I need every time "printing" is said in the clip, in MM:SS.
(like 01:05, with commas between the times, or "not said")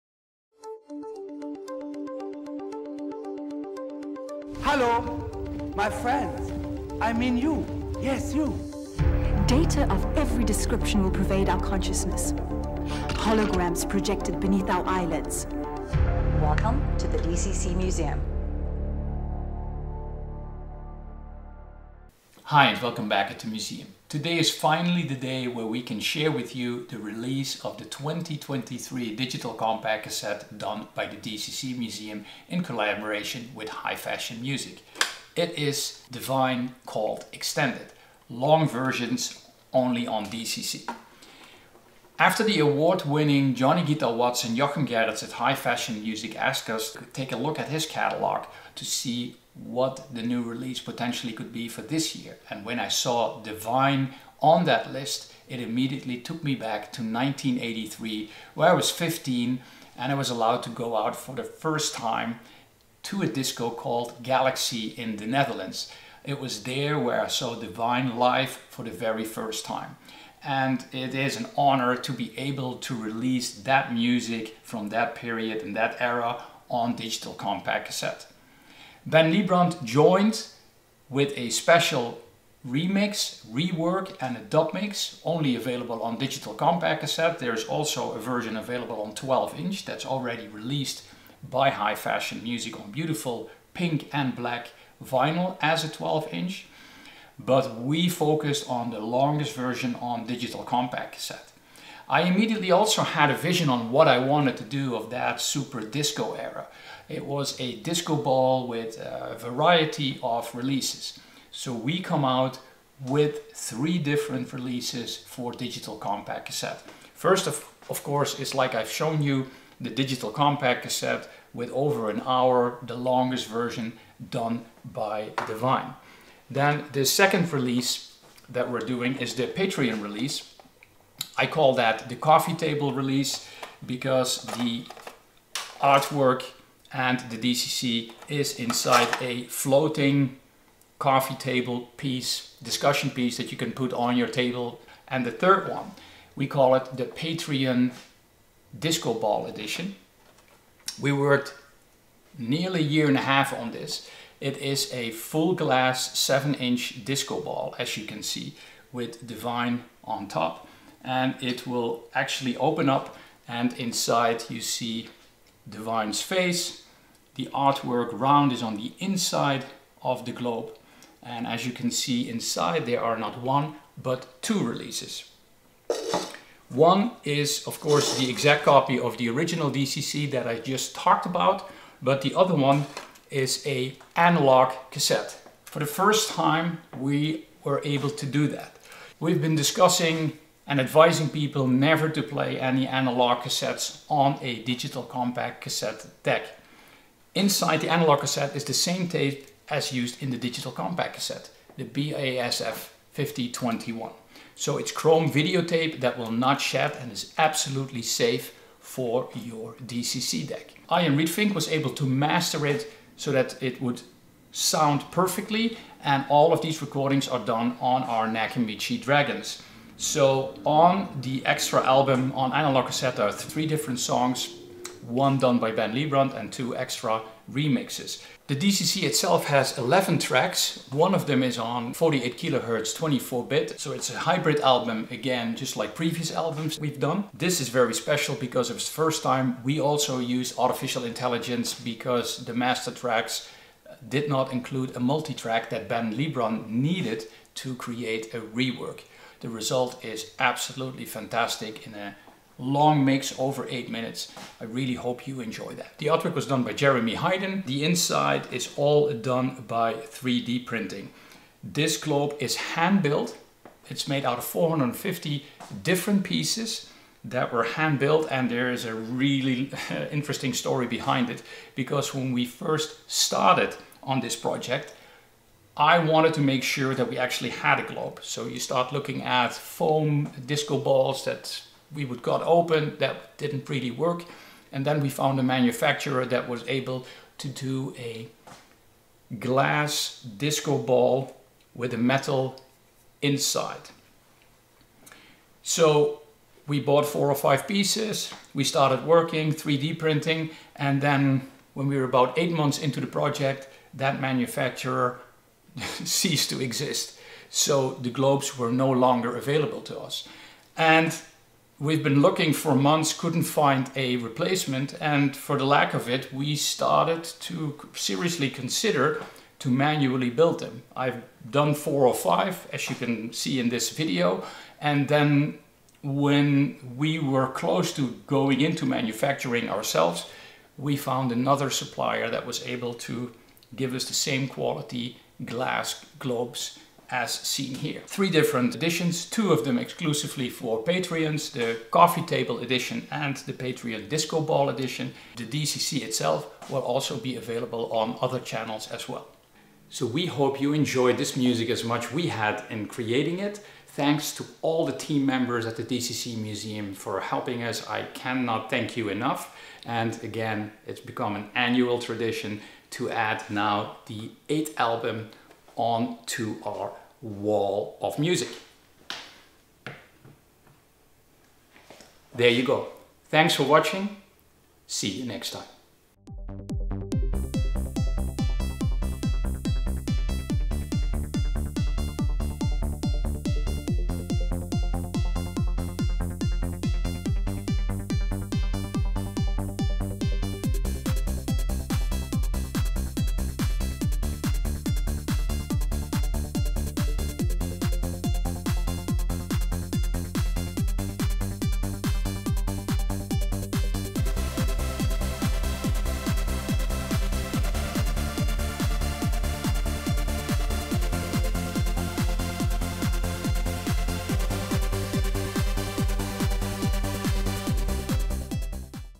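04:20, 04:59.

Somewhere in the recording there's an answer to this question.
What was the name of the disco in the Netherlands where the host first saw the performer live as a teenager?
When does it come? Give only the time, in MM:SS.
01:04.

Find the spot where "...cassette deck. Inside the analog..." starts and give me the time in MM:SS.
03:15.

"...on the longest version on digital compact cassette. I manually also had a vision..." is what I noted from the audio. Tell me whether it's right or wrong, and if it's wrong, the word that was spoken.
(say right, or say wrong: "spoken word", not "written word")
wrong: "immediately", not "manually".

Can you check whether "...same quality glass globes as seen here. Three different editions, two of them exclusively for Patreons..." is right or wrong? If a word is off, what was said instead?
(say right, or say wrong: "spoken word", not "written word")
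right.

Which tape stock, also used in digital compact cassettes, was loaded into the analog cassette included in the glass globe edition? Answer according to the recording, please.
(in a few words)
BASF 5021.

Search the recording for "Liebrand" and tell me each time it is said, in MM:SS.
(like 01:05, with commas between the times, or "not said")
01:19, 03:45, 04:06.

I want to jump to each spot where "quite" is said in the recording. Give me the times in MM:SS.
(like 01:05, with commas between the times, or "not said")
not said.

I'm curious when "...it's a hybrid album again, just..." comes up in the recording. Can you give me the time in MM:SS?
03:53.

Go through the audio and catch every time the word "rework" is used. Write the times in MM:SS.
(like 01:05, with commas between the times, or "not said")
01:23, 04:08.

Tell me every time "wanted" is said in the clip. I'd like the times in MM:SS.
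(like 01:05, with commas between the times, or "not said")
01:44, 04:35.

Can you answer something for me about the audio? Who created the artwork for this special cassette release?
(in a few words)
Jeremy Heiden.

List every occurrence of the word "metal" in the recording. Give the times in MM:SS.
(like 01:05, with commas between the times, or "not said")
04:51.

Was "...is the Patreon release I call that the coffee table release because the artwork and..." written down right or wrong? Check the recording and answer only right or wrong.
right.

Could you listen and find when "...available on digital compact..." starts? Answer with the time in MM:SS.
01:25.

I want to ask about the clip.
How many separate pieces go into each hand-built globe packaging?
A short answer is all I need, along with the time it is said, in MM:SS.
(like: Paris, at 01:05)
450, at 04:24.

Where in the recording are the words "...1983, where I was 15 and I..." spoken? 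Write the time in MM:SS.
00:57.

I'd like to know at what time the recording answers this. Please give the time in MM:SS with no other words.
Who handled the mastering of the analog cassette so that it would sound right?
03:30.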